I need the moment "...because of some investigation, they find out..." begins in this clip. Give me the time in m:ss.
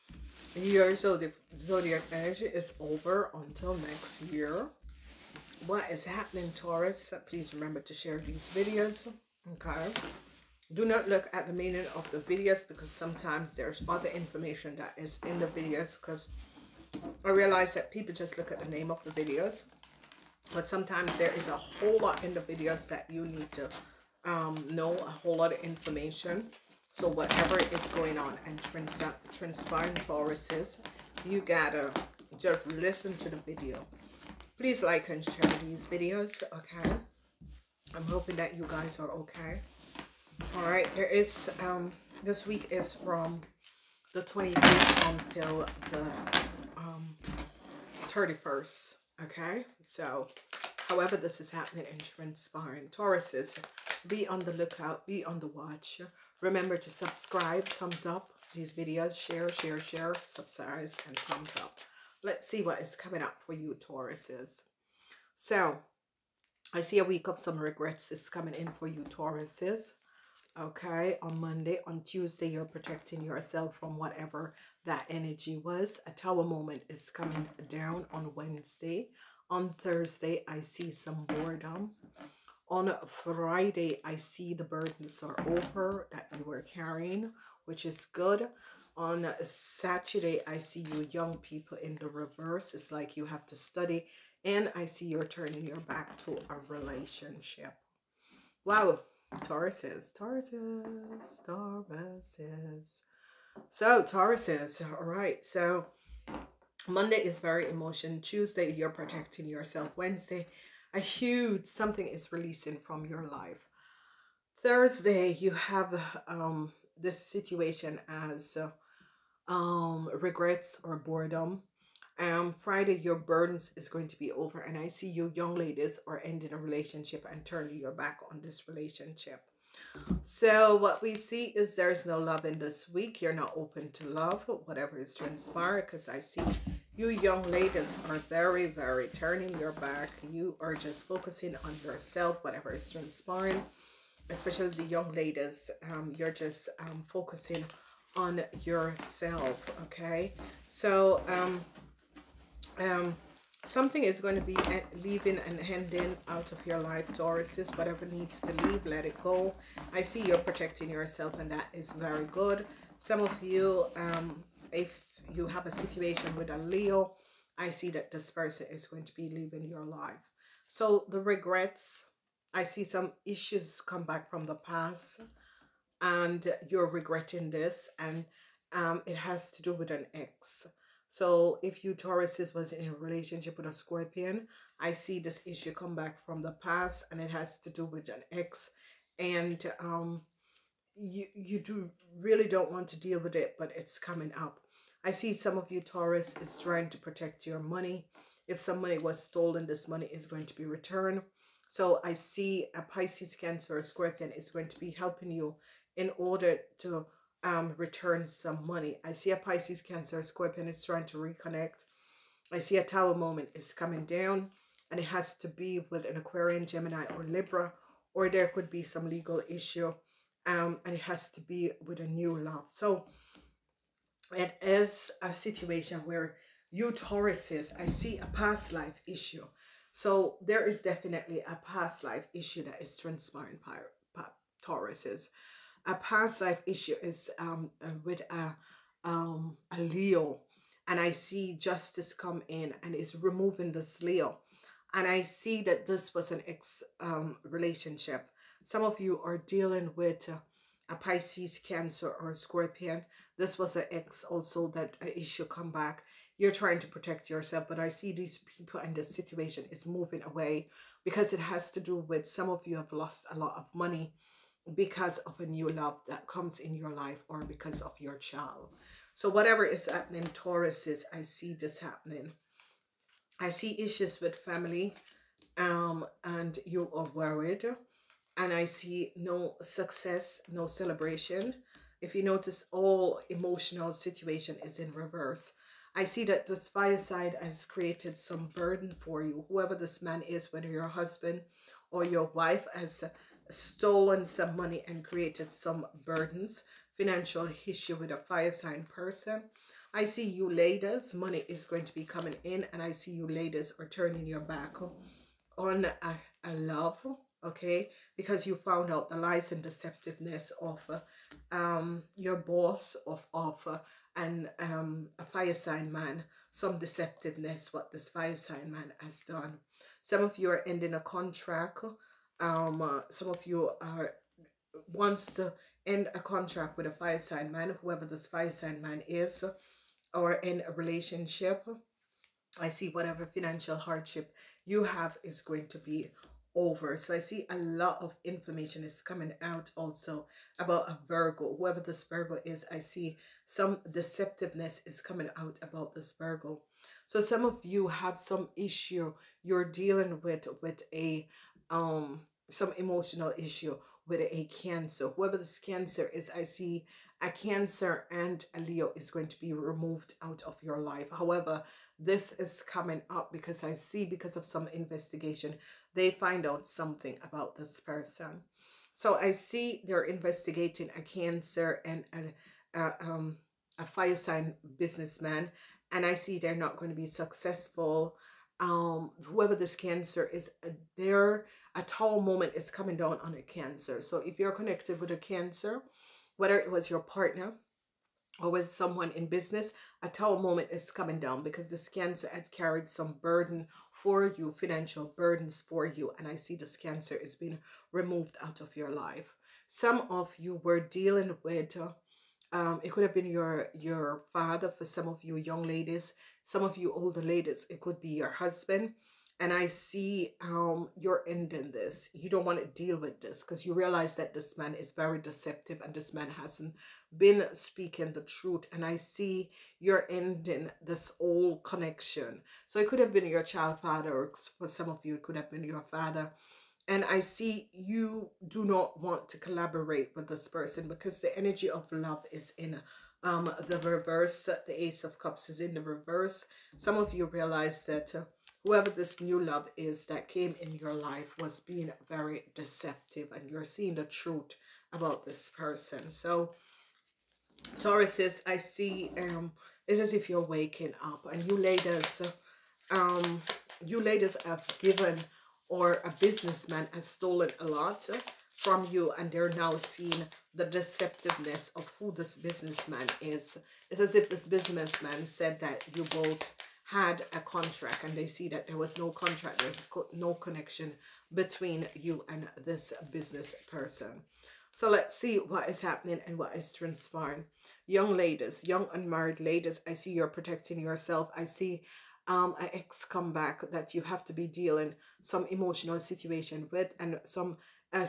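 6:04.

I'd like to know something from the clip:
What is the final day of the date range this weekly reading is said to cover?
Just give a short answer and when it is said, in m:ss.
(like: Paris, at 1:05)
31st, at 0:48.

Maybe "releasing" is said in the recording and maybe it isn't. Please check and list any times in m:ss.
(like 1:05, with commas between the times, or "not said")
1:52.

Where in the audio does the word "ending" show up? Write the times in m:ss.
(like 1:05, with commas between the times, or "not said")
2:06, 2:35, 5:20, 6:51, 7:00.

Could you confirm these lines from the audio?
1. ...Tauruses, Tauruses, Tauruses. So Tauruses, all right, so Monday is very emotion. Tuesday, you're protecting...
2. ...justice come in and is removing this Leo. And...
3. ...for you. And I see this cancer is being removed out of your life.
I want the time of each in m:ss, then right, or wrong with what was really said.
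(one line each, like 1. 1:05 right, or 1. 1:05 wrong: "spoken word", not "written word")
1. 1:39 right
2. 4:01 right
3. 6:35 right.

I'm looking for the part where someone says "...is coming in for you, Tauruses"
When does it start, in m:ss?
1:08.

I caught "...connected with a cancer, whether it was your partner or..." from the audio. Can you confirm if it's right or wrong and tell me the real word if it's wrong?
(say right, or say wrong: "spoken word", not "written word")
right.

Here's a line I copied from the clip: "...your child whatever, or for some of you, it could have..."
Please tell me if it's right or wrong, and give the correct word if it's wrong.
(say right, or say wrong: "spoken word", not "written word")
wrong: "father", not "whatever".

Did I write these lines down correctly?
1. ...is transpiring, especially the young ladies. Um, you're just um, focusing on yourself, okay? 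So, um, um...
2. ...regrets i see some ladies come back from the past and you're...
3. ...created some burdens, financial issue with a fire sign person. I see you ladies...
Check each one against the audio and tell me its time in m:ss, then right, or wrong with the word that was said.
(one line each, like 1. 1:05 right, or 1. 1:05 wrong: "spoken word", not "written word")
1. 2:22 right
2. 2:51 wrong: "issues", not "ladies"
3. 4:55 right.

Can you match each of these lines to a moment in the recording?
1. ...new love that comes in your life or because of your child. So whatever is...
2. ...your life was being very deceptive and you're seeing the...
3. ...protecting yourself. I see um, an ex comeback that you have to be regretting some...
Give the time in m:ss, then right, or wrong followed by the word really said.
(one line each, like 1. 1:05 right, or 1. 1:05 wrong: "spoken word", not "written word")
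1. 4:25 right
2. 7:20 right
3. 8:00 wrong: "dealing", not "regretting".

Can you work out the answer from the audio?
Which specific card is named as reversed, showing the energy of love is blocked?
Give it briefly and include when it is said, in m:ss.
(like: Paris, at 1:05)
Ace of Cups, at 7:14.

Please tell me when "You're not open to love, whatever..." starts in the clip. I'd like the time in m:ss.
2:13.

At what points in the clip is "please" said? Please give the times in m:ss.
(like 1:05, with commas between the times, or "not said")
0:07, 0:34.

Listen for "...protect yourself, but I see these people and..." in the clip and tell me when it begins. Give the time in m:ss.
4:16.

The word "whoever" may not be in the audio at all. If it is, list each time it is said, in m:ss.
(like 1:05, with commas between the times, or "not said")
4:49, 5:27, 5:41, 5:55, 6:19, 7:18.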